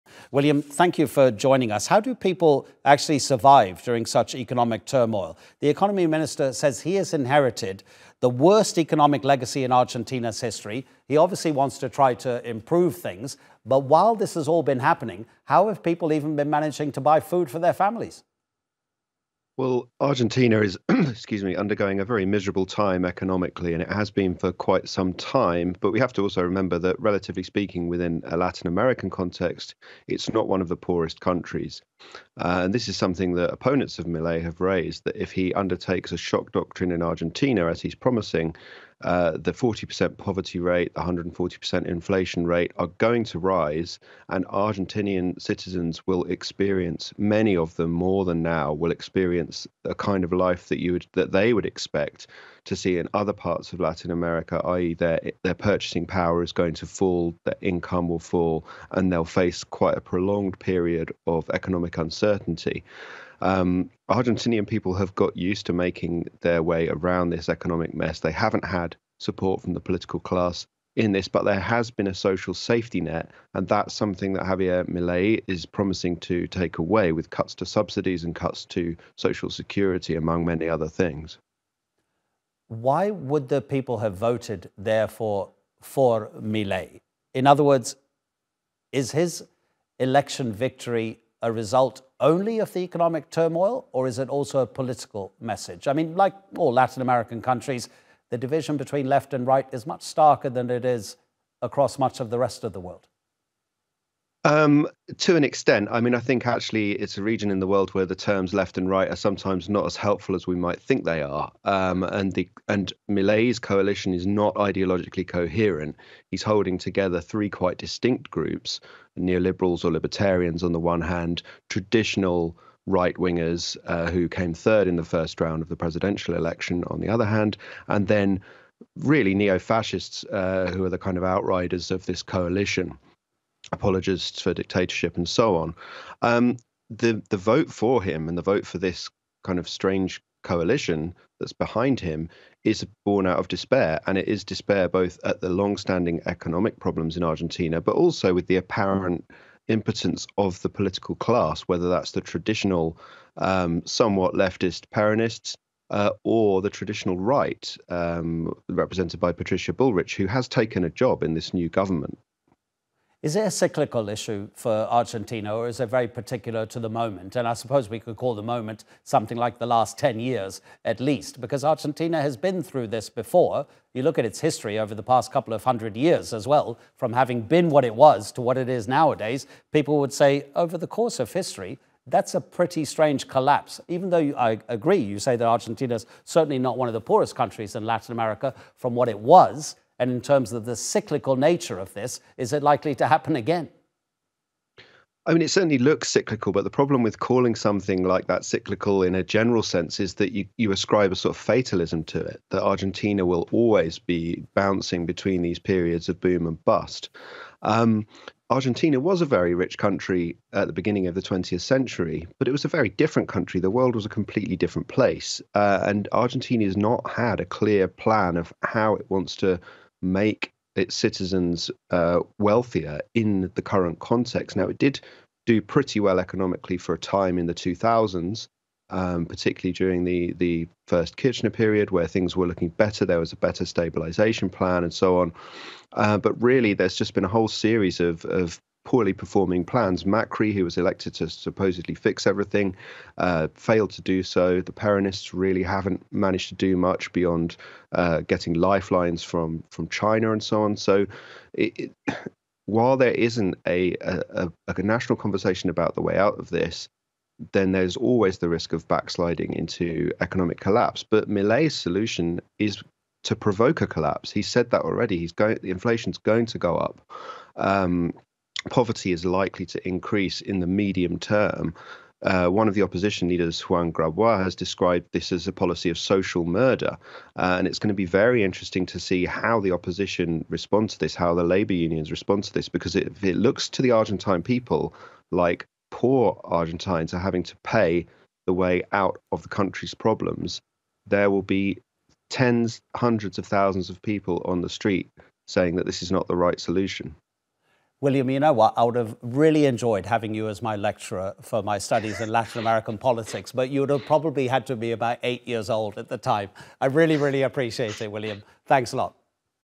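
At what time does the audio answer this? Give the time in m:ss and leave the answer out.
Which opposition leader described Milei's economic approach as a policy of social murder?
4:33.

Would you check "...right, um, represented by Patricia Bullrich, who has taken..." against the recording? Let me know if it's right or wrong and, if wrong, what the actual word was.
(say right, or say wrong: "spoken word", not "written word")
right.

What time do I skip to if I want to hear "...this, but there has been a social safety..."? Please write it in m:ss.
1:11.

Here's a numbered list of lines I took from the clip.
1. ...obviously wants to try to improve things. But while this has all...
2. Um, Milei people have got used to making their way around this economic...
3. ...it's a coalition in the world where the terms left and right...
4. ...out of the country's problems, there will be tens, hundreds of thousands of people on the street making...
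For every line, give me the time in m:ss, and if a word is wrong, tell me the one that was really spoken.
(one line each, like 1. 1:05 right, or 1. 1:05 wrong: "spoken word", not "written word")
1. 0:11 right
2. 1:03 wrong: "Argentinian", not "Milei"
3. 1:46 wrong: "region", not "coalition"
4. 4:48 wrong: "saying", not "making".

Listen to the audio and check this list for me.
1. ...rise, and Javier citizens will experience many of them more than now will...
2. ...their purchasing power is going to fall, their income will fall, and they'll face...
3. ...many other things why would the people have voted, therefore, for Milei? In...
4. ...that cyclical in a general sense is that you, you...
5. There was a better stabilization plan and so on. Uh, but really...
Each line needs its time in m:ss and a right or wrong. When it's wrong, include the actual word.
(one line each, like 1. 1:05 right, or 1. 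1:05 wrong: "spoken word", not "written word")
1. 0:43 wrong: "Argentinian", not "Javier"
2. 0:55 right
3. 1:20 right
4. 3:18 right
5. 3:53 right.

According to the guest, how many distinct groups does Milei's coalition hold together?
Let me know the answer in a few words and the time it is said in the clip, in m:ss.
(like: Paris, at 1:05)
3, at 1:57.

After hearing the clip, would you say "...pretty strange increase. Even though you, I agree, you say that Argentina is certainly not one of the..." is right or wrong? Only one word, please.
wrong.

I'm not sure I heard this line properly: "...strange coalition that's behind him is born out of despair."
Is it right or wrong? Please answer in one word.
right.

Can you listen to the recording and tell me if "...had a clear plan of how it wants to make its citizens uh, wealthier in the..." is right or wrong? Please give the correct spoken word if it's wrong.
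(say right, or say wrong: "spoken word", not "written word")
right.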